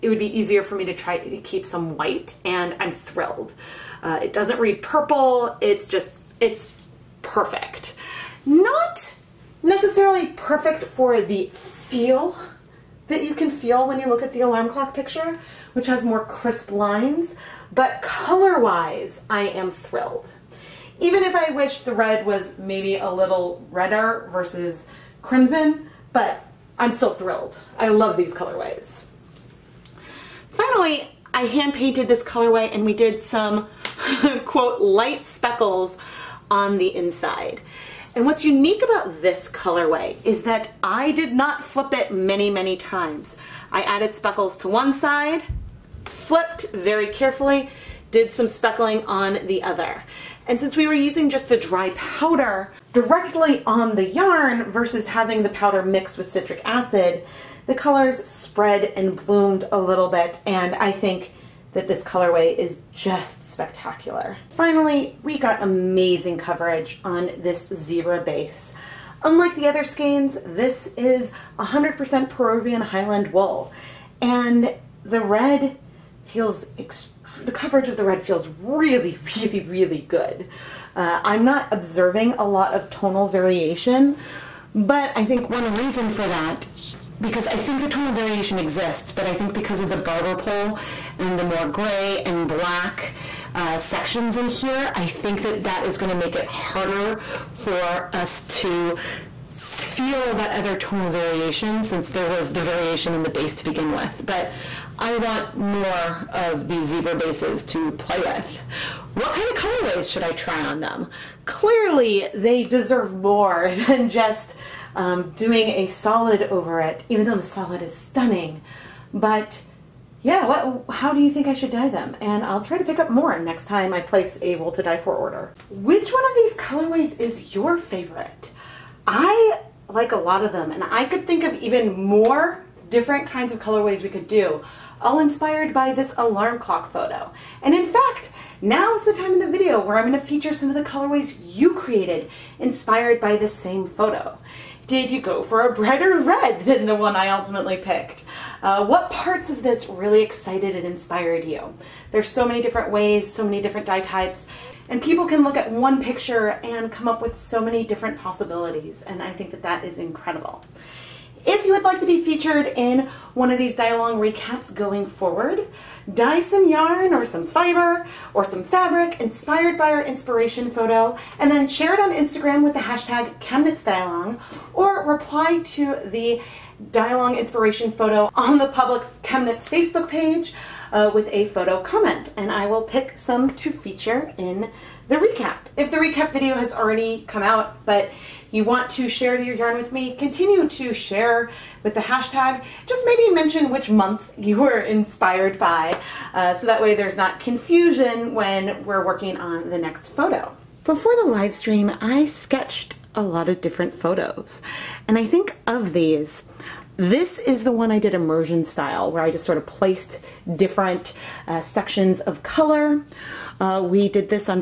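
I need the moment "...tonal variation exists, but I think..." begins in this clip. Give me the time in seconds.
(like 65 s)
87 s.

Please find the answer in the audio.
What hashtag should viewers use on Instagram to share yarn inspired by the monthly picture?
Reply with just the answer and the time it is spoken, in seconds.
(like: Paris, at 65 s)
ChemKnitsDyeAlong, at 173 s.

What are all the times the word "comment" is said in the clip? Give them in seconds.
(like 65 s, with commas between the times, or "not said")
181 s.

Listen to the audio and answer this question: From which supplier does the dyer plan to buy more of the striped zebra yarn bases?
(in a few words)
Wool2Dye4.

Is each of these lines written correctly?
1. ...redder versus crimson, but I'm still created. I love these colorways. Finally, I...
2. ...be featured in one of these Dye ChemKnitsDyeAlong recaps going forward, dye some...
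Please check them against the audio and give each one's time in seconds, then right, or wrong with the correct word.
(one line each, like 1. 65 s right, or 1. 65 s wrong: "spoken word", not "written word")
1. 23 s wrong: "thrilled", not "created"
2. 162 s wrong: "Along", not "ChemKnitsDyeAlong".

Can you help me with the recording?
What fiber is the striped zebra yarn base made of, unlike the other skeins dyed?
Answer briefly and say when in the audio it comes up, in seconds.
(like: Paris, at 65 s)
100% Peruvian Highland wool, at 71 s.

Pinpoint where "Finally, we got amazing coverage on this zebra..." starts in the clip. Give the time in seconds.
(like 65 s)
64 s.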